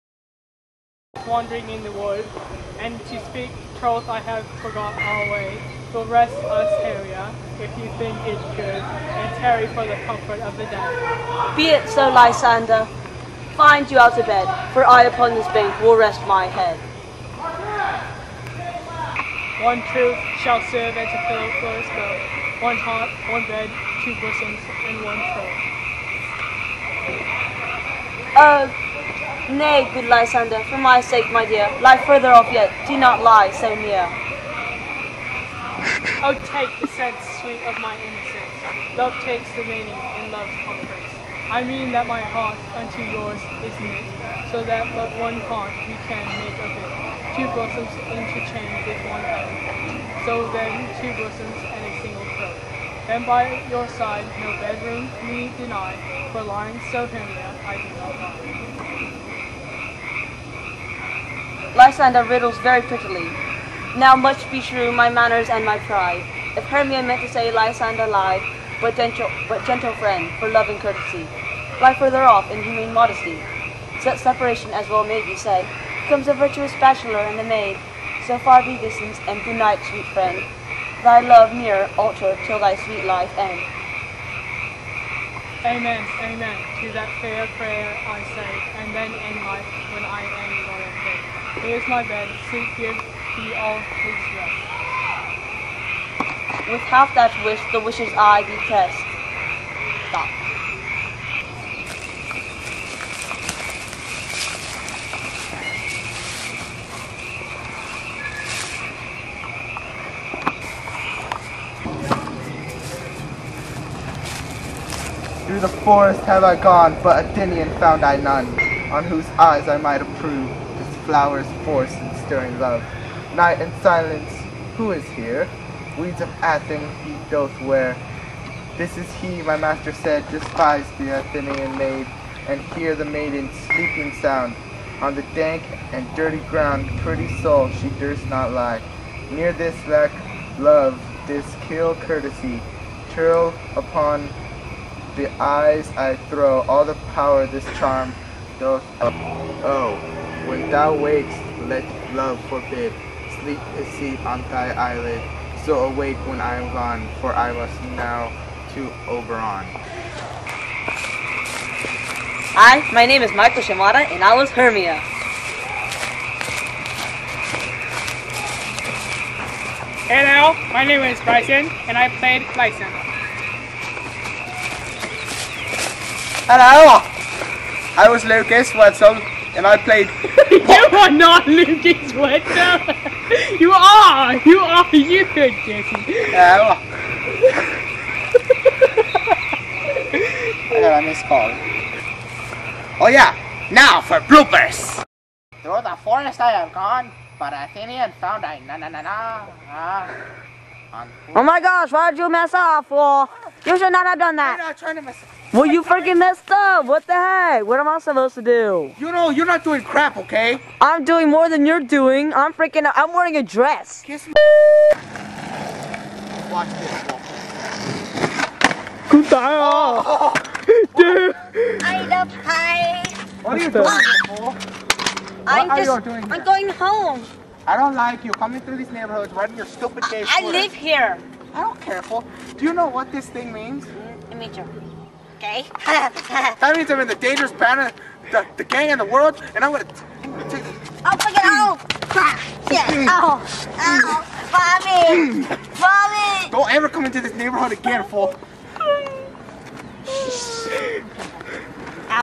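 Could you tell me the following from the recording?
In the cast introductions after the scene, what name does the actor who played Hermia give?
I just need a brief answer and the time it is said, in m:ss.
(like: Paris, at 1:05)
Michael Ciabatta, at 2:43.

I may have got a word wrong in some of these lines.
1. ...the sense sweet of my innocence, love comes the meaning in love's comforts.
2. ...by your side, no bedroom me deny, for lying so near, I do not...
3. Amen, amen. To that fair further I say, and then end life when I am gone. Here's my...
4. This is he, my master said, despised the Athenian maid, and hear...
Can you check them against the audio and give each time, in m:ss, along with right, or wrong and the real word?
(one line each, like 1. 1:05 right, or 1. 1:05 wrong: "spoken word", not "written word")
1. 0:36 wrong: "takes", not "comes"
2. 0:53 right
3. 1:25 wrong: "prayer", not "further"
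4. 2:08 right.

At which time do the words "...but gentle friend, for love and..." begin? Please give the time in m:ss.
1:09.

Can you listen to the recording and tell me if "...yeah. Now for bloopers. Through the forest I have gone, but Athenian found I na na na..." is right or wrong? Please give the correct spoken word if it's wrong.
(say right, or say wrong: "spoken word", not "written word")
right.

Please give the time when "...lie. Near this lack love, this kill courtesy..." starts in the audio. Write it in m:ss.
2:18.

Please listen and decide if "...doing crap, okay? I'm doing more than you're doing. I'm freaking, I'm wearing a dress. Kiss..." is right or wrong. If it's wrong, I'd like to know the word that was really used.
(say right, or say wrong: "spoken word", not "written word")
right.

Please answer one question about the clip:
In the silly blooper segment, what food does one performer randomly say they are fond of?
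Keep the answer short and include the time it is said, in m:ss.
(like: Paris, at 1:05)
Pie, at 3:42.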